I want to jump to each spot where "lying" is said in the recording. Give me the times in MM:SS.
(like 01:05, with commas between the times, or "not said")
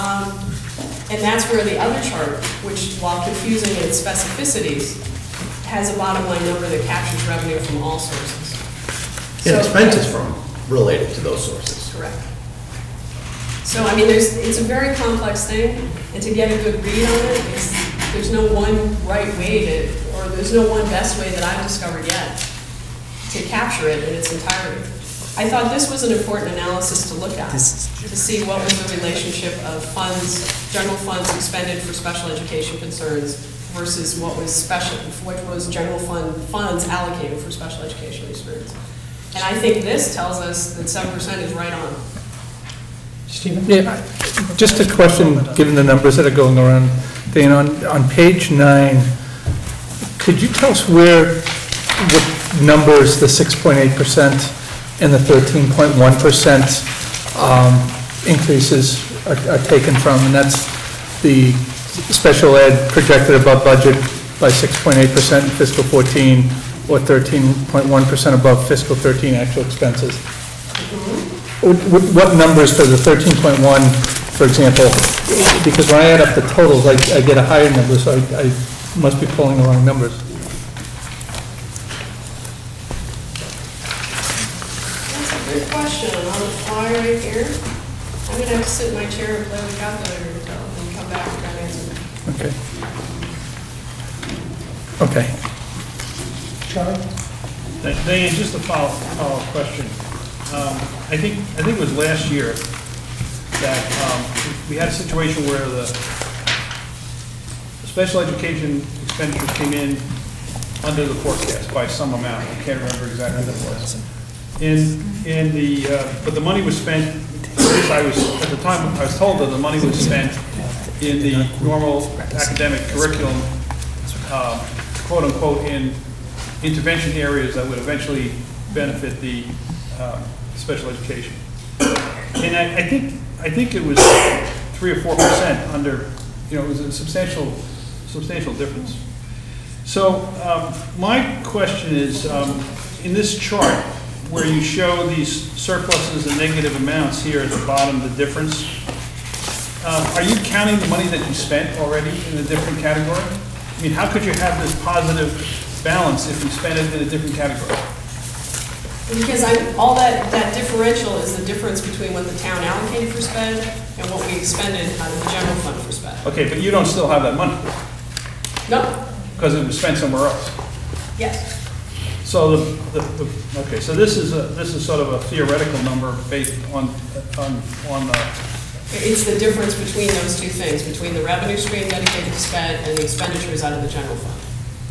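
not said.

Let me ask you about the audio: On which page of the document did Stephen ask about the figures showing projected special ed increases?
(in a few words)
9.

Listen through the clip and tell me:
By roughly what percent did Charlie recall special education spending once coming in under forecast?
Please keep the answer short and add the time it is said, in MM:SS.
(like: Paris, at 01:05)
3 or 4 percent, at 02:14.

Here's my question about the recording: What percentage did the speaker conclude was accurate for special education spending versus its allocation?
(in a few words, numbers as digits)
7%.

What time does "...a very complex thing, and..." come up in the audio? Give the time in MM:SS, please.
00:14.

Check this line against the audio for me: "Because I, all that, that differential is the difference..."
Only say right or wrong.
right.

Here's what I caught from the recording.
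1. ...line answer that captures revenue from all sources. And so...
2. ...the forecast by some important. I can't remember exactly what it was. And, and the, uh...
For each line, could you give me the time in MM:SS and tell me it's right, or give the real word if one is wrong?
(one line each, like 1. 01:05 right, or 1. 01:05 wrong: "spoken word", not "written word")
1. 00:06 wrong: "number", not "answer"
2. 01:51 wrong: "amount", not "important".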